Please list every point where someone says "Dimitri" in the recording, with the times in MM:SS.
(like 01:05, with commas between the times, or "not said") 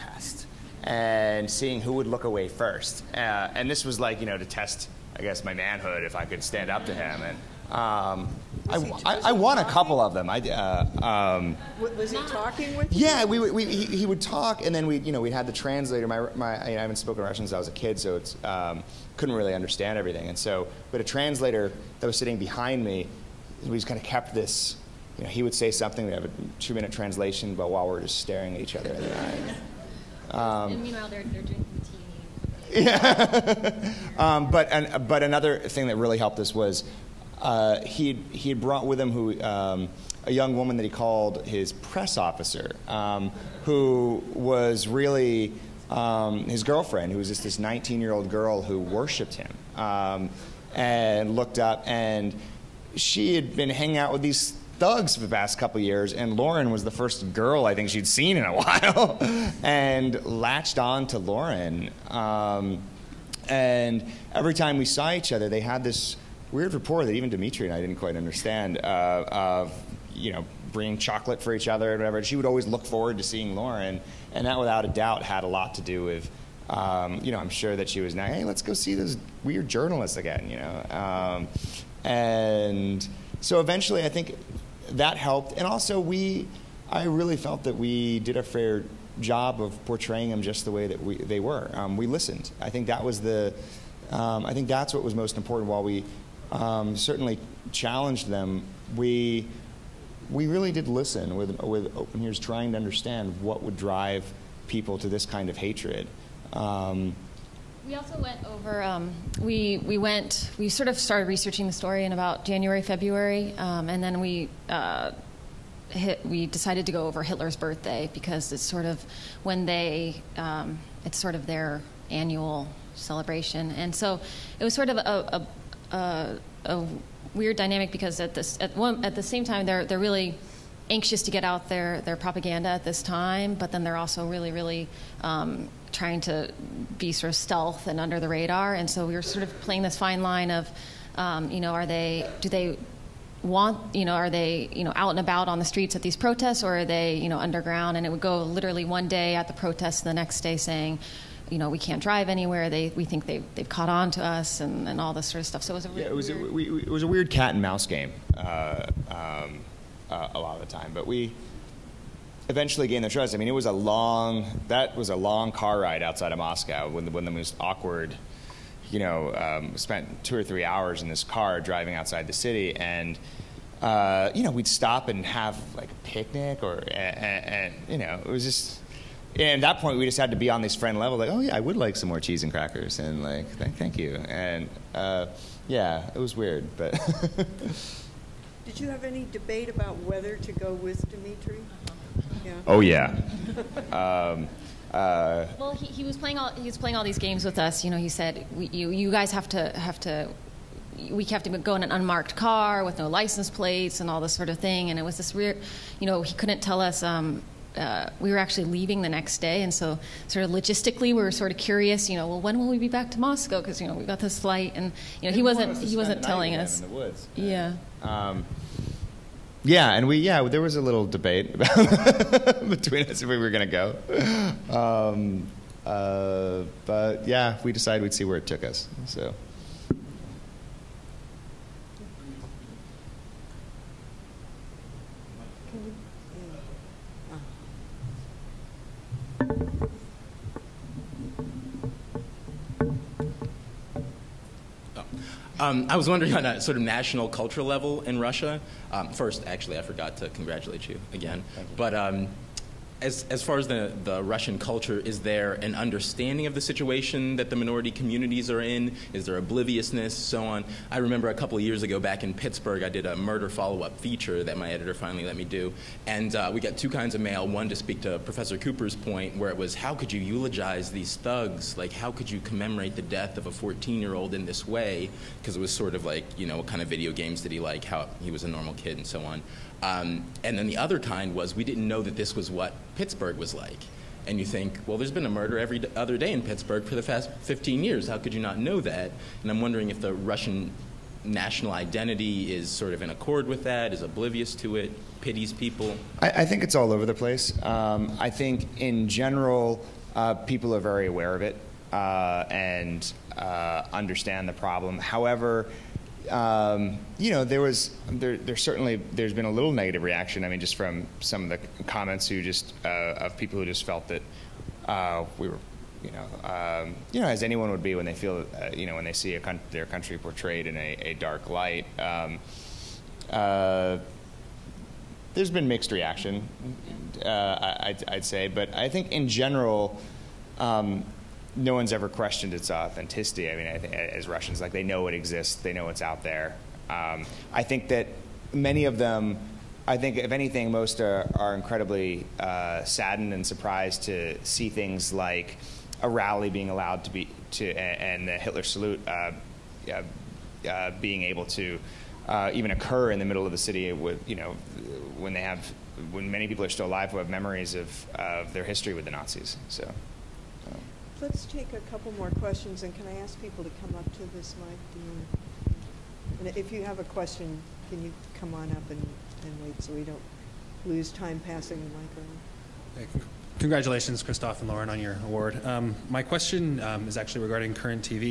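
01:07, 03:11.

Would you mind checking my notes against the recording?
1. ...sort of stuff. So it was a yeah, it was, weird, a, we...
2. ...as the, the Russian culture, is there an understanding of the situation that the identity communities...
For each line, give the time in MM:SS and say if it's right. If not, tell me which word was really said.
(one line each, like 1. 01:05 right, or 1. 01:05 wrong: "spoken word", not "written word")
1. 02:35 right
2. 04:13 wrong: "minority", not "identity".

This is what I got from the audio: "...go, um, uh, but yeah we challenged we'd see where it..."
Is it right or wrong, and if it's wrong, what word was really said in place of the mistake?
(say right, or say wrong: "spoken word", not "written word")
wrong: "decided", not "challenged".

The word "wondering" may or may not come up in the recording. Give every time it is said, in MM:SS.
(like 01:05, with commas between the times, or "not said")
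04:06, 04:49.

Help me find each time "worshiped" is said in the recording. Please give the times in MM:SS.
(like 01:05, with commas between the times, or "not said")
00:48.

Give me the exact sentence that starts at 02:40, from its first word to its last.
But we, eventually gain their trust.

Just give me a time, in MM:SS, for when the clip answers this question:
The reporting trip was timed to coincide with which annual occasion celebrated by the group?
01:57.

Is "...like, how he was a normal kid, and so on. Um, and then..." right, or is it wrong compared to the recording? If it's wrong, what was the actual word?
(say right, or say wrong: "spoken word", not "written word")
right.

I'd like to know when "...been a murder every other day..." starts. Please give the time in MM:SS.
04:45.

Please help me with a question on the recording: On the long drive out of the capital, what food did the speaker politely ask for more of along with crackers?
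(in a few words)
Cheese.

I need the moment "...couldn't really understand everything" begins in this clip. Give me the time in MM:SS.
00:19.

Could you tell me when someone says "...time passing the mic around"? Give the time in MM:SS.
06:11.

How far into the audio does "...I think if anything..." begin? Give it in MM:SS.
05:39.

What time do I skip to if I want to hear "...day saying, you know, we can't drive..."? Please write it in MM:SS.
02:30.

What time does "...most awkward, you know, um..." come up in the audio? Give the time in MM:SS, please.
02:47.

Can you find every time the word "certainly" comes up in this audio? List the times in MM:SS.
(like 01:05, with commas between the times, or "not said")
01:36, 05:08.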